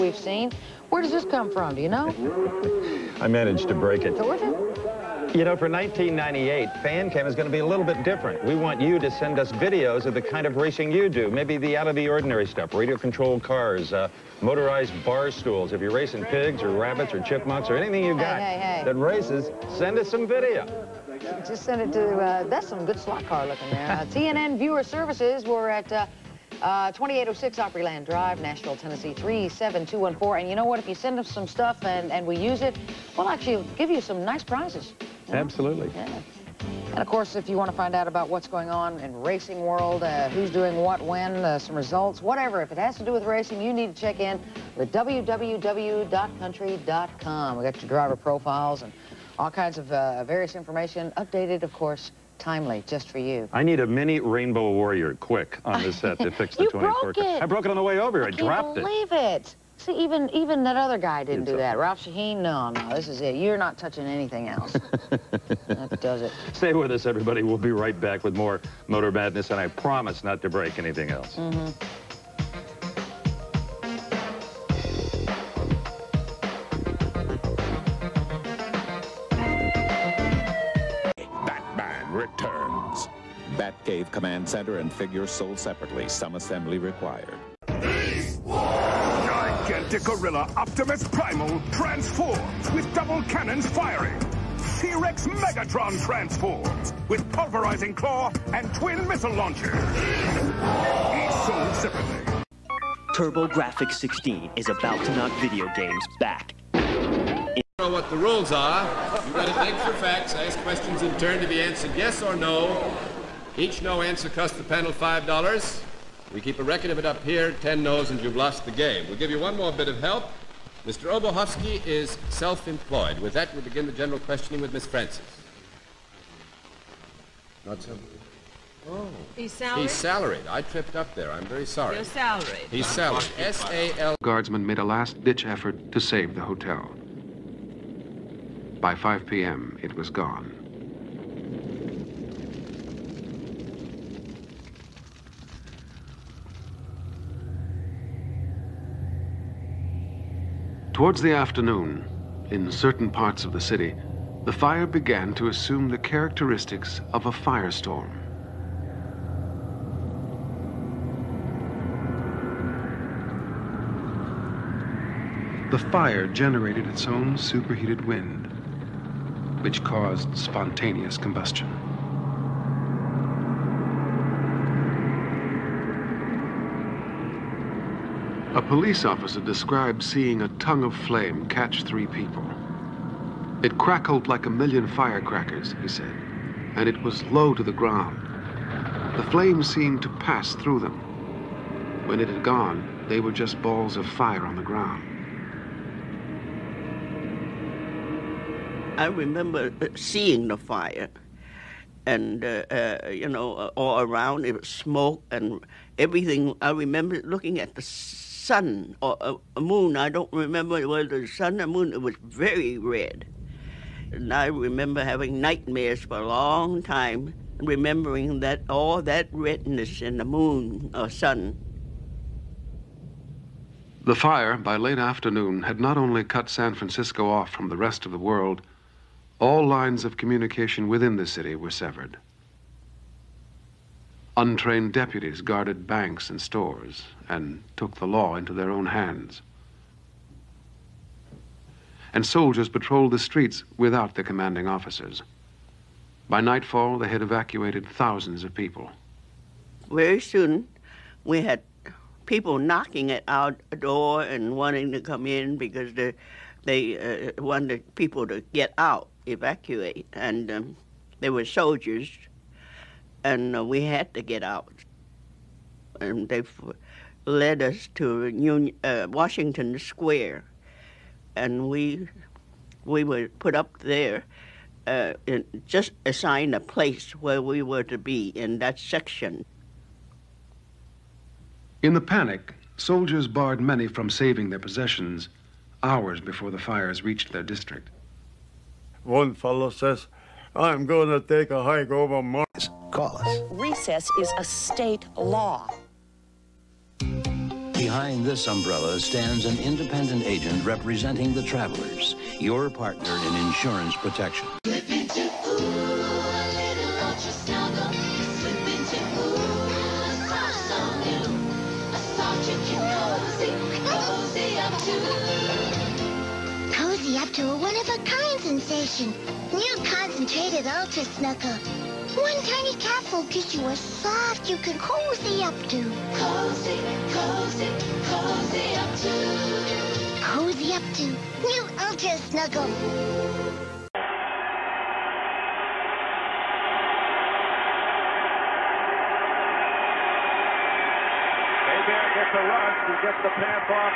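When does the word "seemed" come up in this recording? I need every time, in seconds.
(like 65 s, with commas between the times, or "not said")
189 s.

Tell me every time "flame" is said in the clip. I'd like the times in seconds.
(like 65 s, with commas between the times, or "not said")
180 s, 189 s.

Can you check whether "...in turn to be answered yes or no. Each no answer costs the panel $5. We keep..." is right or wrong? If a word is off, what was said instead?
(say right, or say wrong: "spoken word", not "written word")
right.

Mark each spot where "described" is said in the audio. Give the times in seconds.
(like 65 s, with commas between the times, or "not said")
179 s.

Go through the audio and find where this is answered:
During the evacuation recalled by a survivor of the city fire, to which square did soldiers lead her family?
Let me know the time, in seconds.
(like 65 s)
269 s.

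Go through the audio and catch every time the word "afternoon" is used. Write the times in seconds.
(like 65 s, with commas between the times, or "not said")
151 s, 224 s.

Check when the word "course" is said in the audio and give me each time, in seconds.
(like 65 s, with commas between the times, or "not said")
37 s, 51 s.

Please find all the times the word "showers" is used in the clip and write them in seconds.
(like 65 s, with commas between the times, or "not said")
not said.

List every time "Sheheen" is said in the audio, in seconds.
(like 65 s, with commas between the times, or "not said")
62 s.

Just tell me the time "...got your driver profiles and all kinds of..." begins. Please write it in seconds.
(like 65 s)
47 s.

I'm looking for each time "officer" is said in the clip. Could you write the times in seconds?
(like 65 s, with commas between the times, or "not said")
179 s, 244 s.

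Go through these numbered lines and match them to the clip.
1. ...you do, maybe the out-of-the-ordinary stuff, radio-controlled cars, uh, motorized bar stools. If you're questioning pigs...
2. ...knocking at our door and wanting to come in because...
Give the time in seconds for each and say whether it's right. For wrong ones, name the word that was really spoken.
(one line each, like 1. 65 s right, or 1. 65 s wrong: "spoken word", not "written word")
1. 10 s wrong: "racing", not "questioning"
2. 252 s right.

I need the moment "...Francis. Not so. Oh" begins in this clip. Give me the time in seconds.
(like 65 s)
124 s.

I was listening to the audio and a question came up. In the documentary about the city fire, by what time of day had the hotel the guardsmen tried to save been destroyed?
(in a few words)
5 p.m.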